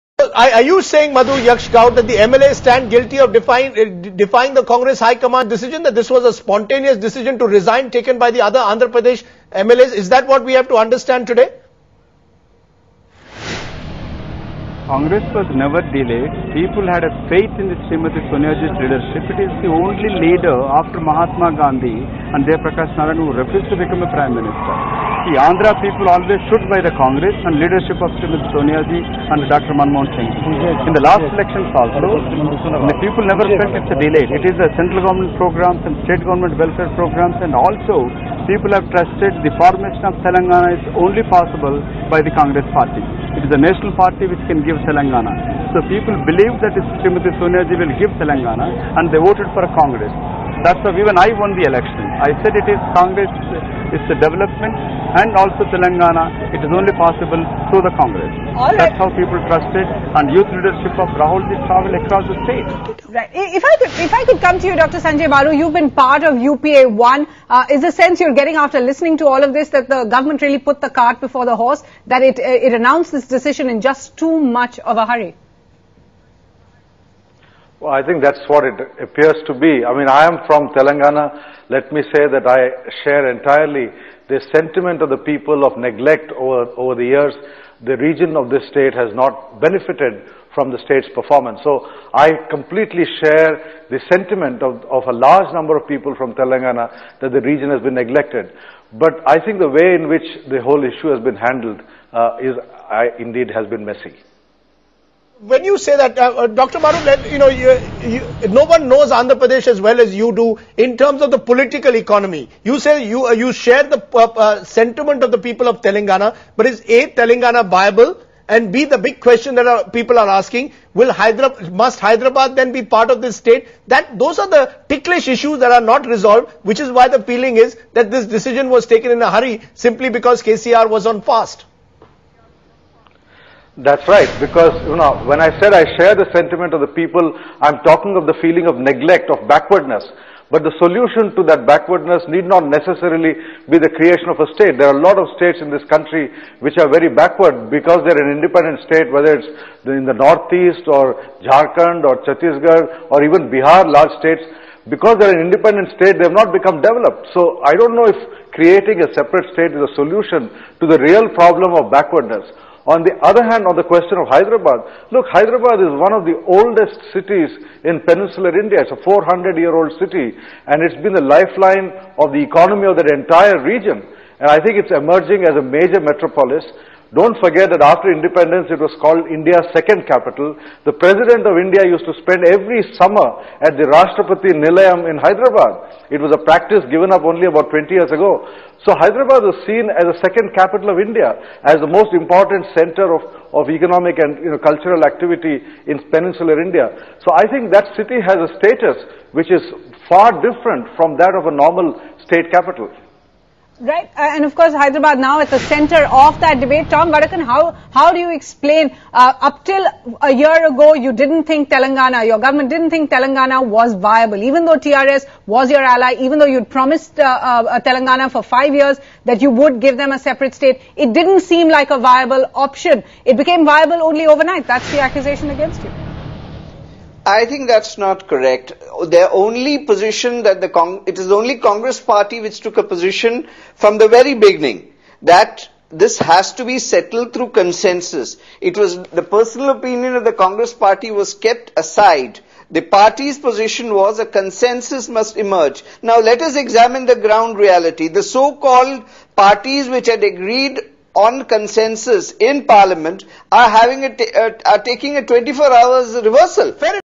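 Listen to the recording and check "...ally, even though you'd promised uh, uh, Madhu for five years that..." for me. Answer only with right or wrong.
wrong.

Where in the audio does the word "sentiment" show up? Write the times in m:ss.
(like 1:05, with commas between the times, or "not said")
1:24, 1:34, 1:54, 2:16.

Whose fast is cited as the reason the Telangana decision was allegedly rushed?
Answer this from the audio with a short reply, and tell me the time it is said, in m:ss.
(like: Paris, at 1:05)
KCR, at 2:10.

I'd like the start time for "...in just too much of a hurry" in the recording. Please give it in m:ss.
1:13.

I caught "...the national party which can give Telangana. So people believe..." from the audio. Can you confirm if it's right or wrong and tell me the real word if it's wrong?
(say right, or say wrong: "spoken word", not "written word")
right.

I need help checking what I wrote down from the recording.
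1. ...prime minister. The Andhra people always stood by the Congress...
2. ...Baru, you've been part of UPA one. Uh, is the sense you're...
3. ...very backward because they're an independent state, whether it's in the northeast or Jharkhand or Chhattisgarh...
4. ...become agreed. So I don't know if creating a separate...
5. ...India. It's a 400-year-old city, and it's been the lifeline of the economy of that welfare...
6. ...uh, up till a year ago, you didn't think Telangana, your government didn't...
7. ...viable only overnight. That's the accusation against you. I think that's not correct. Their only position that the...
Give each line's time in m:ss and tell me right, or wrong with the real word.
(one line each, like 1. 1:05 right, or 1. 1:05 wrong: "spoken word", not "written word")
1. 0:24 right
2. 1:05 right
3. 2:26 right
4. 2:36 wrong: "developed", not "agreed"
5. 2:48 wrong: "entire", not "welfare"
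6. 3:29 right
7. 3:43 right.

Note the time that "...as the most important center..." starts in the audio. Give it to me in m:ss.
3:11.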